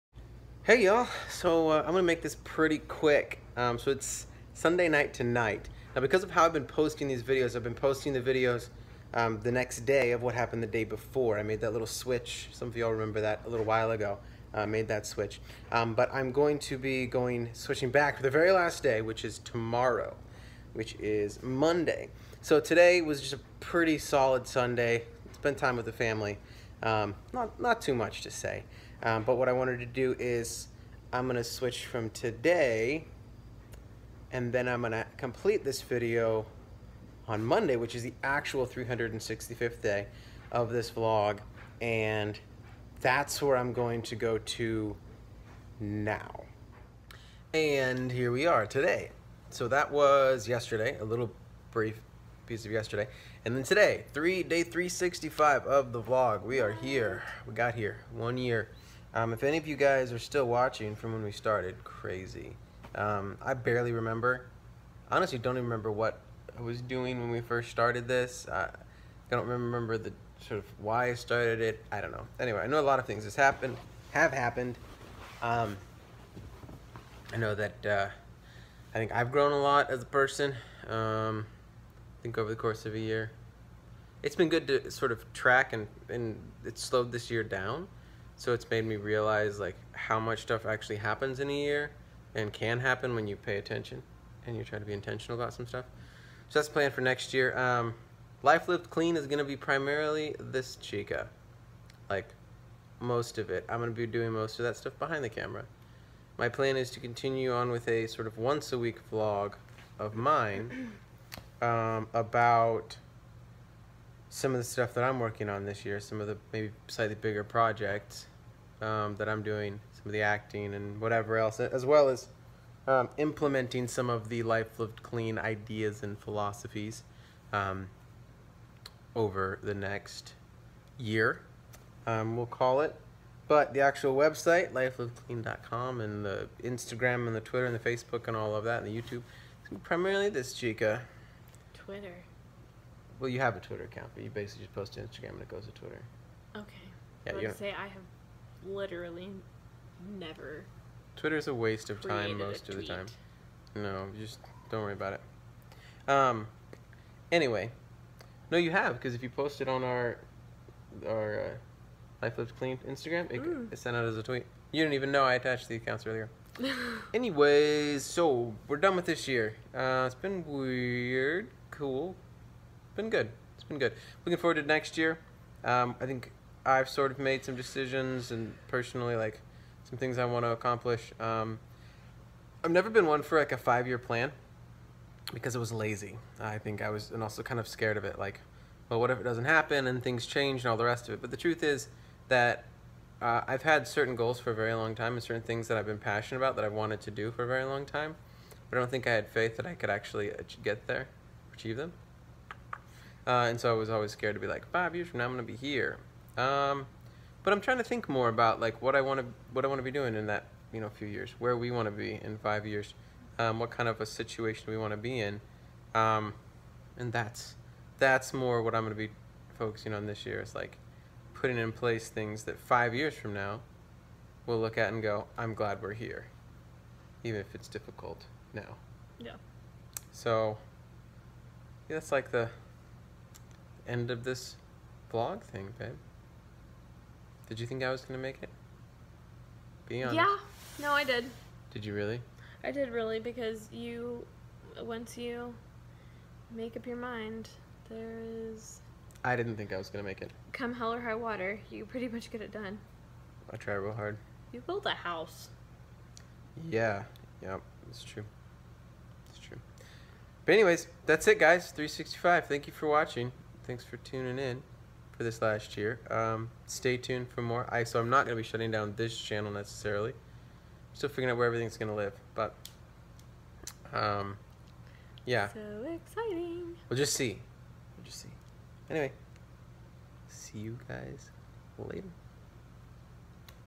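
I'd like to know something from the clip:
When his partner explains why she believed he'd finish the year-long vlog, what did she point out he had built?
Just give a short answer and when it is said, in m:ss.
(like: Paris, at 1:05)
a house, at 4:14.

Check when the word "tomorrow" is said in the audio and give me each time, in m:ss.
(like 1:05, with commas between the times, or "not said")
0:19.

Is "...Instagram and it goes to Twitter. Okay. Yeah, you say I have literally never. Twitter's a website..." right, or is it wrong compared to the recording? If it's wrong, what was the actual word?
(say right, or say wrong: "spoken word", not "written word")
wrong: "waste", not "website".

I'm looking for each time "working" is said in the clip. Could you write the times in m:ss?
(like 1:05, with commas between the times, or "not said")
1:55.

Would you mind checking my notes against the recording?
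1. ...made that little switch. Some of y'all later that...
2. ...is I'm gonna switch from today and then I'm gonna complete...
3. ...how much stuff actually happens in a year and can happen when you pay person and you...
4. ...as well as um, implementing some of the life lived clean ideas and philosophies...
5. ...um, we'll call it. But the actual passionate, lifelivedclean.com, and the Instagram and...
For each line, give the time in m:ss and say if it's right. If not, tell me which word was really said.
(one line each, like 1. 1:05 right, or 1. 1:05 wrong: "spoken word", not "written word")
1. 0:11 wrong: "remember", not "later"
2. 0:30 right
3. 1:29 wrong: "attention", not "person"
4. 2:01 right
5. 2:12 wrong: "website", not "passionate".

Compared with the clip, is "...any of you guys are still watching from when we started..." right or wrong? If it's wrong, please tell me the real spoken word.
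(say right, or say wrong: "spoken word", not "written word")
right.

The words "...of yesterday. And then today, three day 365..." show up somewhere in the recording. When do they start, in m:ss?
0:52.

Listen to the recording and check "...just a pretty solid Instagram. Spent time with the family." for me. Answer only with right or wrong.
wrong.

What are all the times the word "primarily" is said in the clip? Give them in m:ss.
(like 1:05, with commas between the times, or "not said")
1:39, 2:19.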